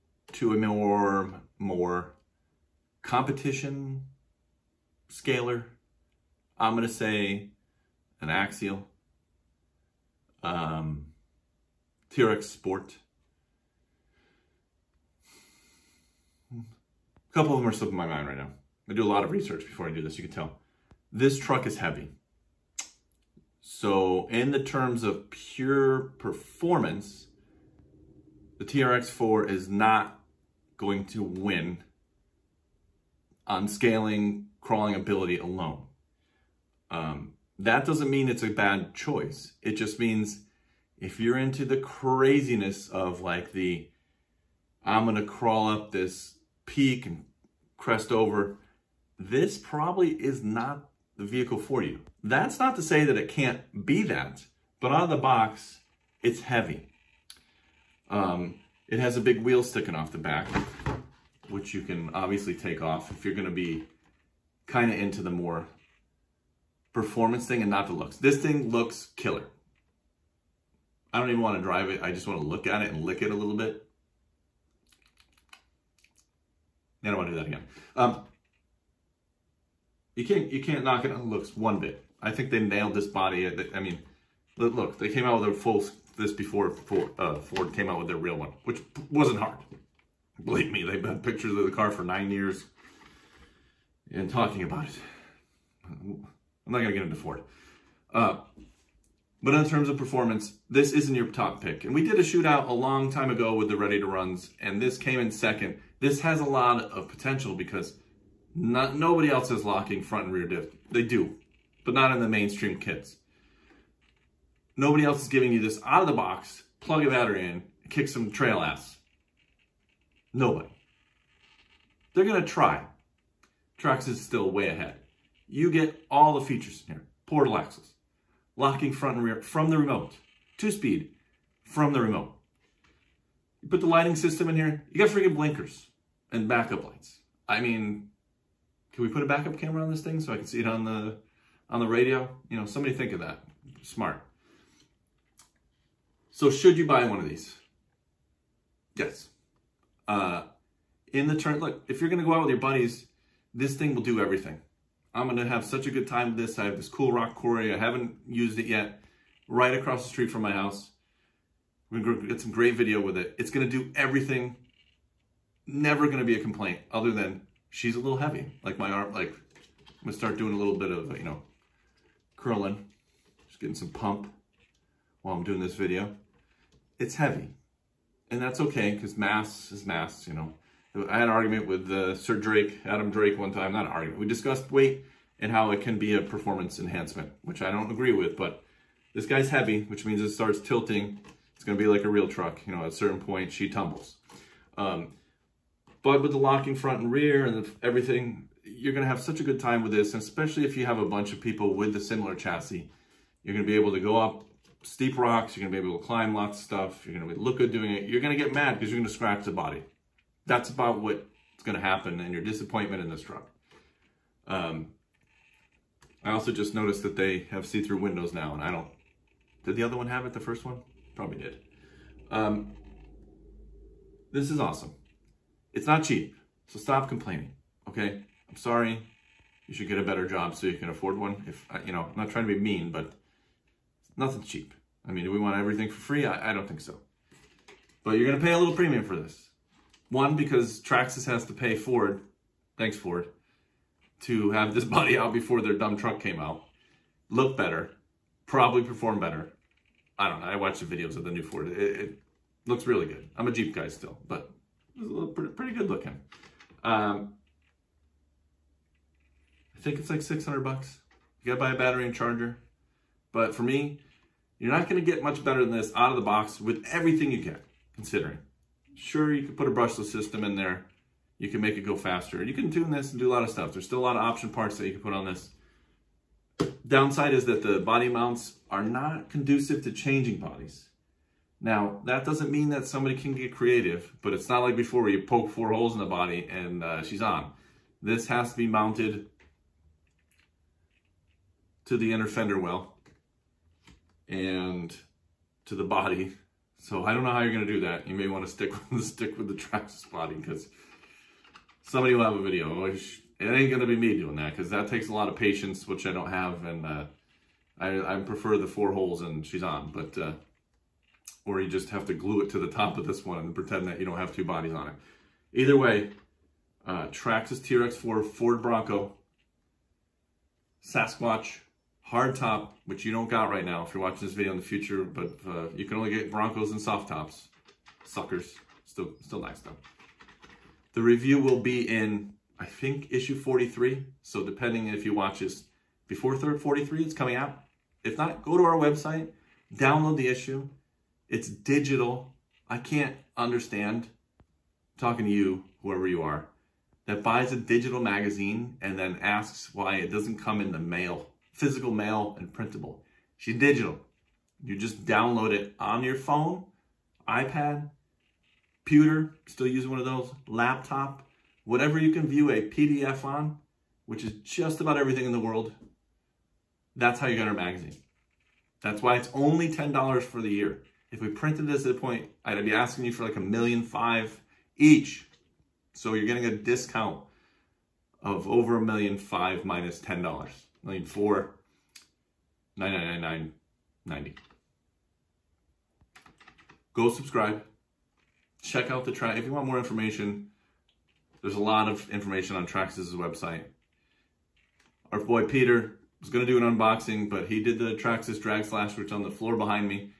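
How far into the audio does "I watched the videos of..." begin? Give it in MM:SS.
04:10.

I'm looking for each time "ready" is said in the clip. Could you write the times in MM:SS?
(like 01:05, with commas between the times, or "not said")
01:43.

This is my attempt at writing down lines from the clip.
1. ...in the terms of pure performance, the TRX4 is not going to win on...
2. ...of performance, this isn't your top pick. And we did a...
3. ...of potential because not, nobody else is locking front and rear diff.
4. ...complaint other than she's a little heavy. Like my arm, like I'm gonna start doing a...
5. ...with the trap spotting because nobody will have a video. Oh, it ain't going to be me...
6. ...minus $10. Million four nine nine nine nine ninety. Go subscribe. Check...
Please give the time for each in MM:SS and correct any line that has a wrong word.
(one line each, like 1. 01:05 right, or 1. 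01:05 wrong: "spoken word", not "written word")
1. 00:24 right
2. 01:39 right
3. 01:46 right
4. 02:46 right
5. 04:59 wrong: "somebody", not "nobody"
6. 06:19 right.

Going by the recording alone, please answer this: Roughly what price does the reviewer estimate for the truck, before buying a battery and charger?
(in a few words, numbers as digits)
$600.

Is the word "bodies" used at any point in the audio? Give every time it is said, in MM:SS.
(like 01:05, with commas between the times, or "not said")
04:40, 05:14.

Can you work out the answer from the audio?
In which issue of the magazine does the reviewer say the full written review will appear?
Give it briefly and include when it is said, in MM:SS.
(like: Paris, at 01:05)
Issue 43, at 05:33.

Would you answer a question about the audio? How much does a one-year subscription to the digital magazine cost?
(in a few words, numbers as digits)
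$10.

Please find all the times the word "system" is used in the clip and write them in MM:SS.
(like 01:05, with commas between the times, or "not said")
02:14, 04:30.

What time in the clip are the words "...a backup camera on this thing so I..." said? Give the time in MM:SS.
02:19.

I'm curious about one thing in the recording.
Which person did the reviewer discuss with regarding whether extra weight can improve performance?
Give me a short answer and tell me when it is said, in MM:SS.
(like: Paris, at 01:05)
Adam Drake, at 03:02.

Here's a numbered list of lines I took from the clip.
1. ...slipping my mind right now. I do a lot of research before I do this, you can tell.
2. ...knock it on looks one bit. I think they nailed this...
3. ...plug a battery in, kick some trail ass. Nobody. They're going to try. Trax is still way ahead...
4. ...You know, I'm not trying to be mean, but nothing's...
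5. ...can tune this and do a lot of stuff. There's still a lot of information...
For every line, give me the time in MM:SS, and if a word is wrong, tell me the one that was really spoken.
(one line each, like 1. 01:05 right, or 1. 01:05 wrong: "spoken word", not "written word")
1. 00:17 right
2. 01:20 right
3. 01:56 right
4. 03:51 right
5. 04:32 wrong: "option", not "information".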